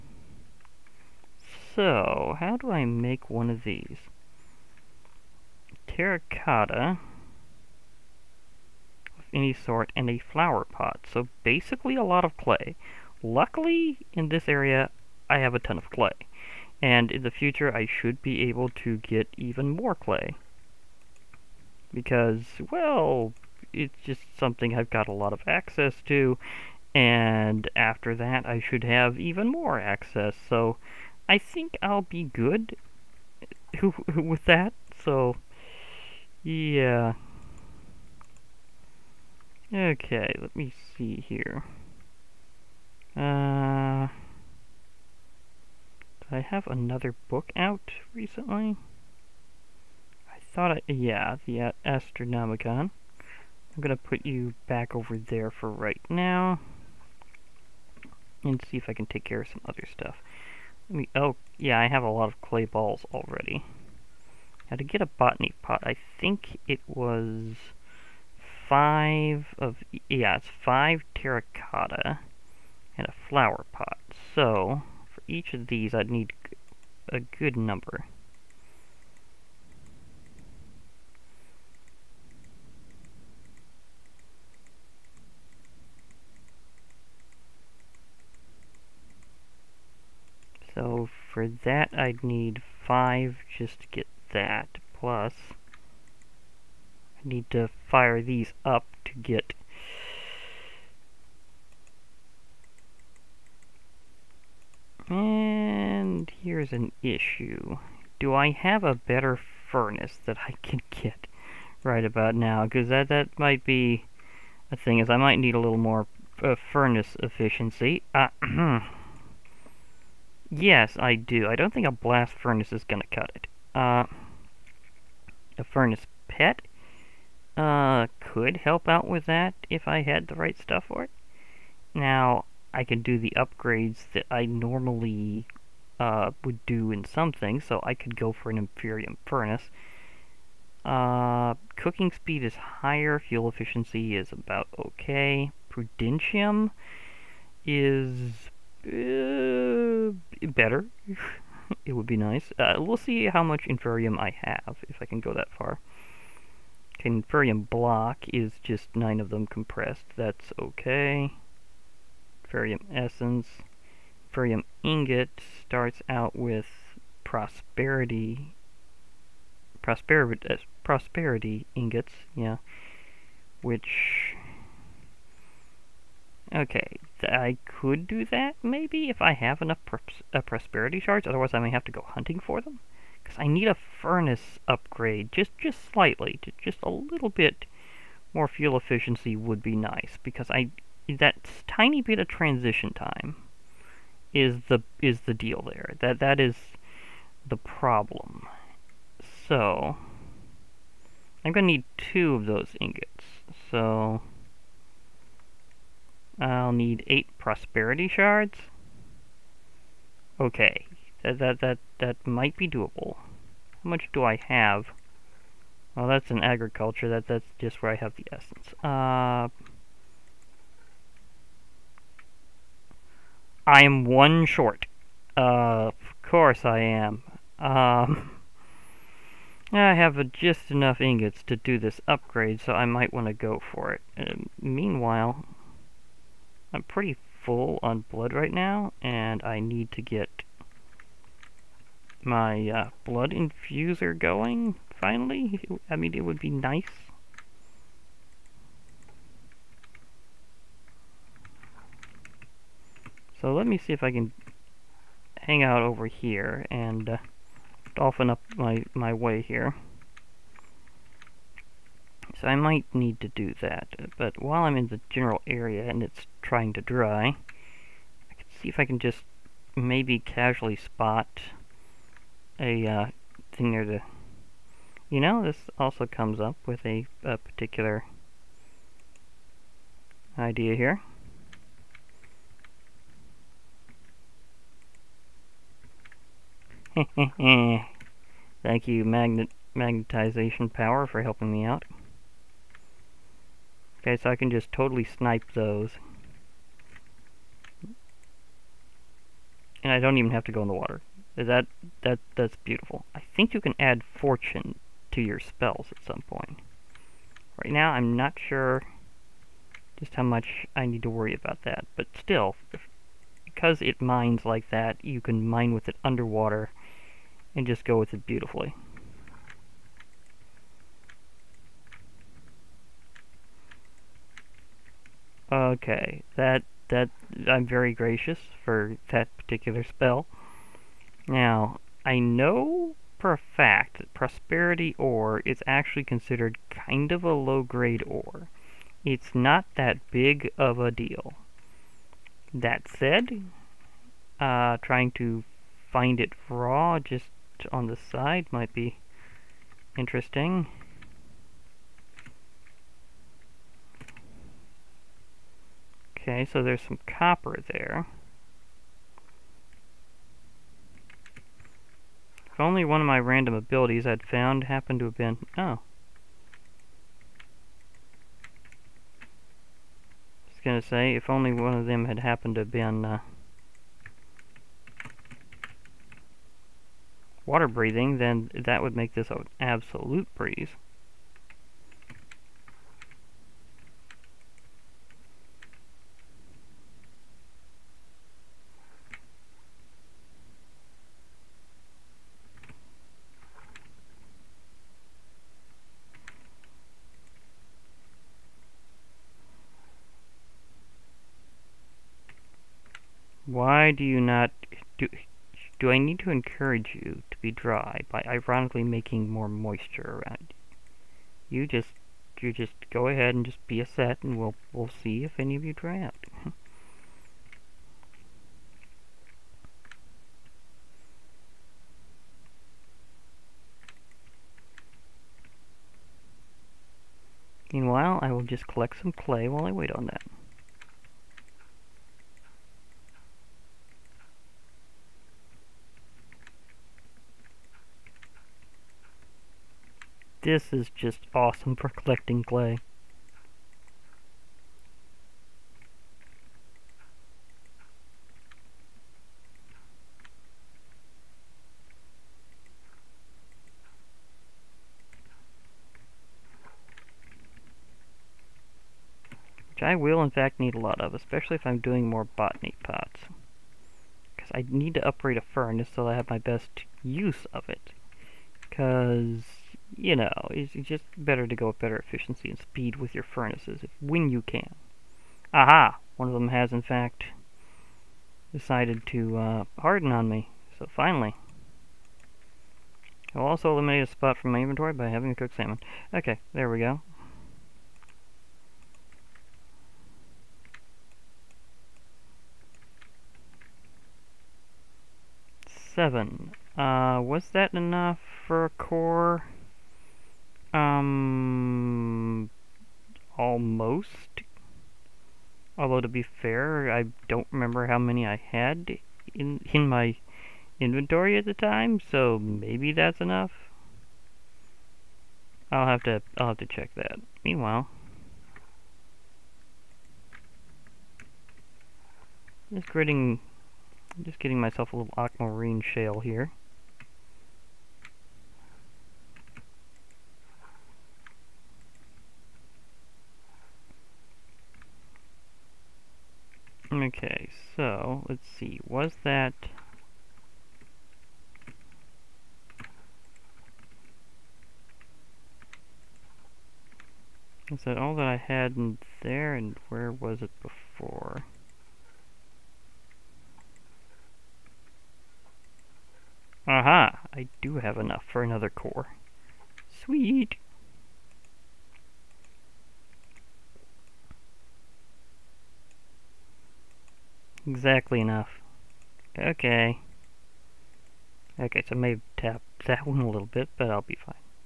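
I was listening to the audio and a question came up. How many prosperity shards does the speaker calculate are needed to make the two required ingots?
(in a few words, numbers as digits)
8.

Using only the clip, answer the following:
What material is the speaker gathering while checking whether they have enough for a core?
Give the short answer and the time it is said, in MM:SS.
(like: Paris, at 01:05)
Aquamarine shale, at 08:45.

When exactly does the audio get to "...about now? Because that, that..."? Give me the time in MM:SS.
01:52.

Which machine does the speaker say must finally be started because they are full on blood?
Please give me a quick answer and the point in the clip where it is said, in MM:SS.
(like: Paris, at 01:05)
Blood infuser, at 04:03.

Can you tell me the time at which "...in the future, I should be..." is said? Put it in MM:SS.
00:17.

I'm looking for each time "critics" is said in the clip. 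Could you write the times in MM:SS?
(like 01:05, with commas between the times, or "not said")
not said.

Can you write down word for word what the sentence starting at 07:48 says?
Because you know, it's just better to go at better efficiency and speed with your furnaces if, when you can.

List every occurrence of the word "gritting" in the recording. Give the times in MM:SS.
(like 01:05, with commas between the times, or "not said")
08:42.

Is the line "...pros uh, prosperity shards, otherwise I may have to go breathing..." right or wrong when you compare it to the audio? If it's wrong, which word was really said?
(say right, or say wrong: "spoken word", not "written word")
wrong: "hunting", not "breathing".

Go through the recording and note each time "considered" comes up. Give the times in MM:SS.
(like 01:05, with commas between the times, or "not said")
05:36.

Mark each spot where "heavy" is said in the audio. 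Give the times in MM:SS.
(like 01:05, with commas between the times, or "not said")
not said.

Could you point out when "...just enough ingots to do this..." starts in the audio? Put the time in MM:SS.
03:50.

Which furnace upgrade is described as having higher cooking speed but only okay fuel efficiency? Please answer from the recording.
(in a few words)
Inferium Furnace.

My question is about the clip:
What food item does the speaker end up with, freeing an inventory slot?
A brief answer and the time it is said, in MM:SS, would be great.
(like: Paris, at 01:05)
Cooked salmon, at 08:05.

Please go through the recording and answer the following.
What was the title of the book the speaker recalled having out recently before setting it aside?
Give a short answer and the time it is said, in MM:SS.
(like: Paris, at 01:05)
Astronomicon, at 00:51.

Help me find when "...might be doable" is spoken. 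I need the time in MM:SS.
03:32.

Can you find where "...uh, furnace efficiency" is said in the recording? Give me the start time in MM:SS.
01:56.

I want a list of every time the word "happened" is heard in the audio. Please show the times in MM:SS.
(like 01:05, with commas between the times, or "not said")
06:04, 06:12.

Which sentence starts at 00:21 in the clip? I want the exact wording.
Because, well, it's just something I've got a lot of access to.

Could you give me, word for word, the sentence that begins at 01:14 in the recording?
So, for each of these I'd need a good number.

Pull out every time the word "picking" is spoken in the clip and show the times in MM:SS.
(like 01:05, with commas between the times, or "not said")
not said.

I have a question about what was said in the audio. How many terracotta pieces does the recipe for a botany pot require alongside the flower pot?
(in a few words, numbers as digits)
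5.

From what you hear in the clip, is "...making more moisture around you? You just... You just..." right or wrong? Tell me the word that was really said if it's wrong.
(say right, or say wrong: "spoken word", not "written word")
right.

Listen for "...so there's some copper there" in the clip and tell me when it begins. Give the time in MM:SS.
05:56.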